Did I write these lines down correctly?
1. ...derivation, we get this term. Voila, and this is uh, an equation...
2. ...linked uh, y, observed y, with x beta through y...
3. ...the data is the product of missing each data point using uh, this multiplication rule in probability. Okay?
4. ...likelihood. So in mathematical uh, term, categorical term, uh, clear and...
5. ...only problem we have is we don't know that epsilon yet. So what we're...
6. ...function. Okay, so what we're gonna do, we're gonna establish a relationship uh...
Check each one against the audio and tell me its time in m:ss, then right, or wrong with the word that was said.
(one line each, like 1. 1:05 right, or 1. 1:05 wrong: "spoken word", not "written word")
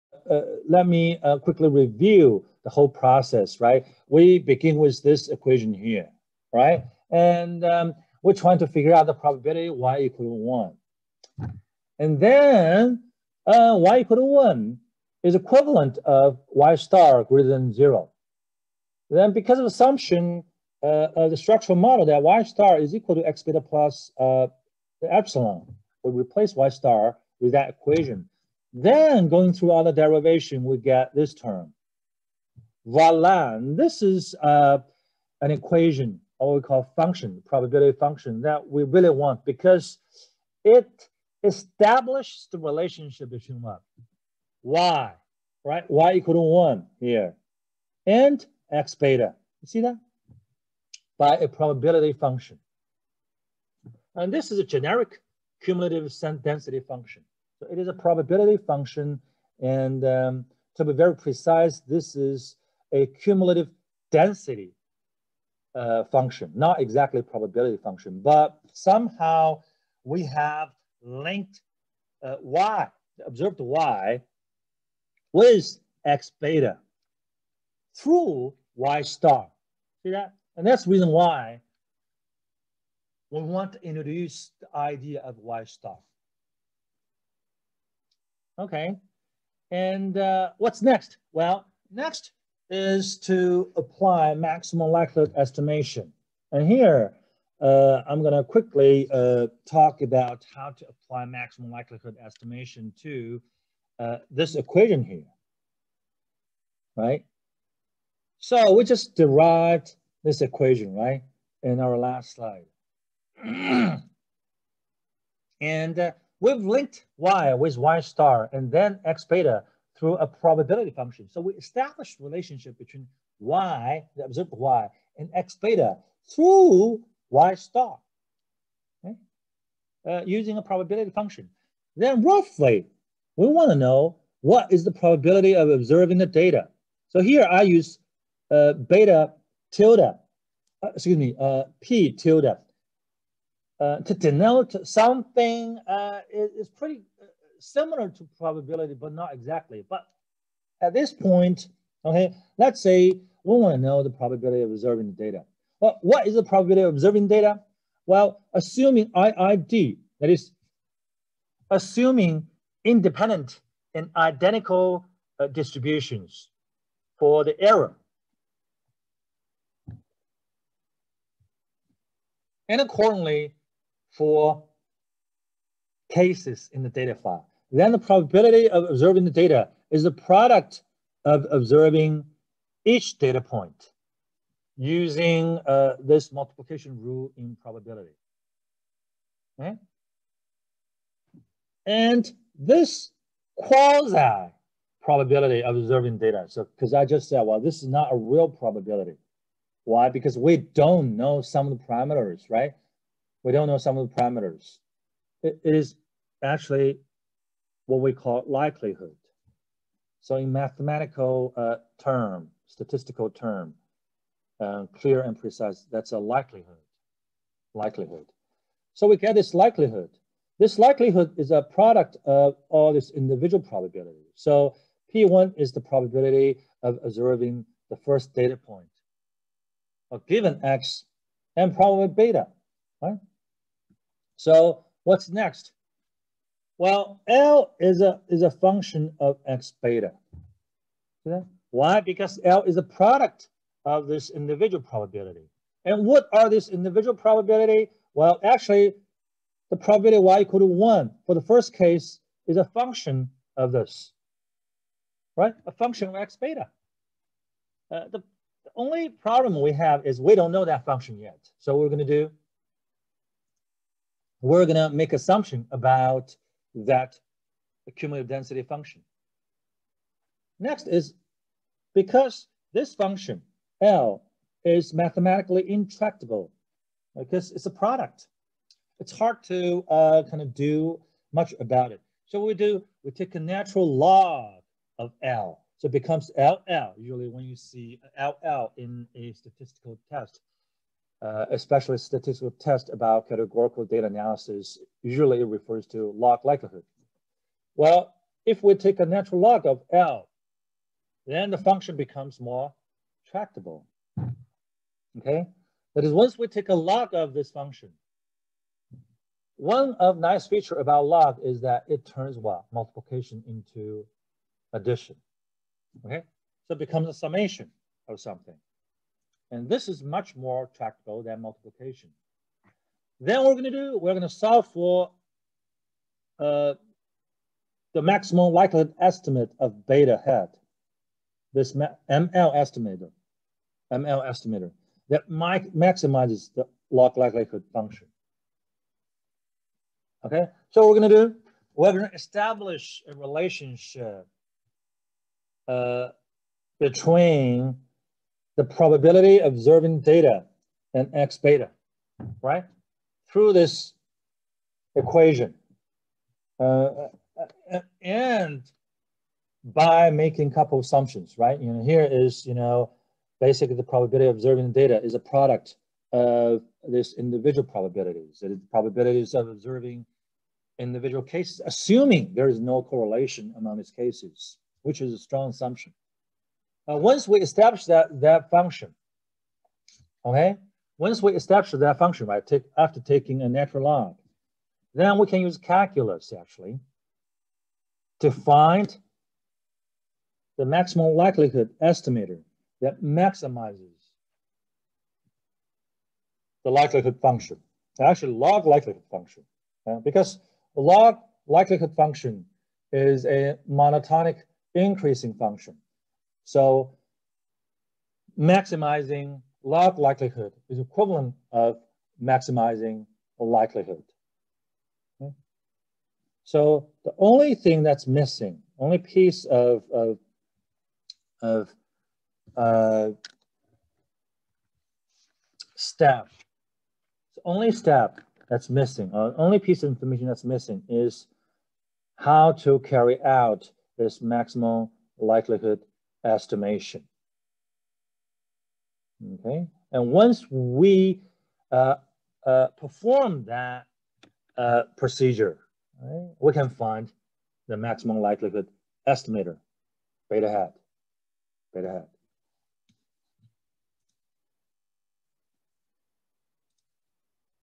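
1. 0:29 right
2. 1:11 right
3. 2:59 wrong: "observing", not "missing"
4. 3:28 wrong: "statistical", not "categorical"
5. 4:18 wrong: "function", not "epsilon"
6. 5:37 right.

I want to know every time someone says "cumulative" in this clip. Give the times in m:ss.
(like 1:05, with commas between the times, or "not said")
0:55, 1:03, 4:27.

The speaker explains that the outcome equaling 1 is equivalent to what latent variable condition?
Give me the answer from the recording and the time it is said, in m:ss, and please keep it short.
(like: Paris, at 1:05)
y star greater than 0, at 0:16.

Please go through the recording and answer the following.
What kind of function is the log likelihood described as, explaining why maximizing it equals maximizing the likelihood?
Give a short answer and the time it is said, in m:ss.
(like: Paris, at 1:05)
monotonic increasing function, at 6:43.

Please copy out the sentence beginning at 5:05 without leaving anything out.
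That is, once we take a log of this function, one of nice feature about log is that it turns what?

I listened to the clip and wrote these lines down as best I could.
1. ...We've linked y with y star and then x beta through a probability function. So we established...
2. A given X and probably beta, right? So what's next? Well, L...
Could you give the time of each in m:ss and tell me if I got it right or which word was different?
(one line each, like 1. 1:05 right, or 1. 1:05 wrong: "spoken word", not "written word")
1. 1:56 right
2. 3:50 right.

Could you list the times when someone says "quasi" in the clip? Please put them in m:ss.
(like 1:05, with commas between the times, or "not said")
3:13.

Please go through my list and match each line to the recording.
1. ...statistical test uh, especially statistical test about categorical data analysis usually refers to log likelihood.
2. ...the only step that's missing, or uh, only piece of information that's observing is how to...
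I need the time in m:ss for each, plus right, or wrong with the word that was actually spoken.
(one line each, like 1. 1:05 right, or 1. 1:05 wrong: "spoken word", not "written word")
1. 4:49 right
2. 7:07 wrong: "missing", not "observing".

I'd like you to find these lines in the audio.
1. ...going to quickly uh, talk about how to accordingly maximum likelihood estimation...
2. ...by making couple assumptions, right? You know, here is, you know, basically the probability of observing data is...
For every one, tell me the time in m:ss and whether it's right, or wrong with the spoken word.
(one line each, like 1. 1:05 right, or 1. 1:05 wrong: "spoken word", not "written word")
1. 1:38 wrong: "apply", not "accordingly"
2. 5:59 right.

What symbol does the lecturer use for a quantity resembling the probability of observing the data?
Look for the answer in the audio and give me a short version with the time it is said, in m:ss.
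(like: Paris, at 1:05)
p tilde, at 2:21.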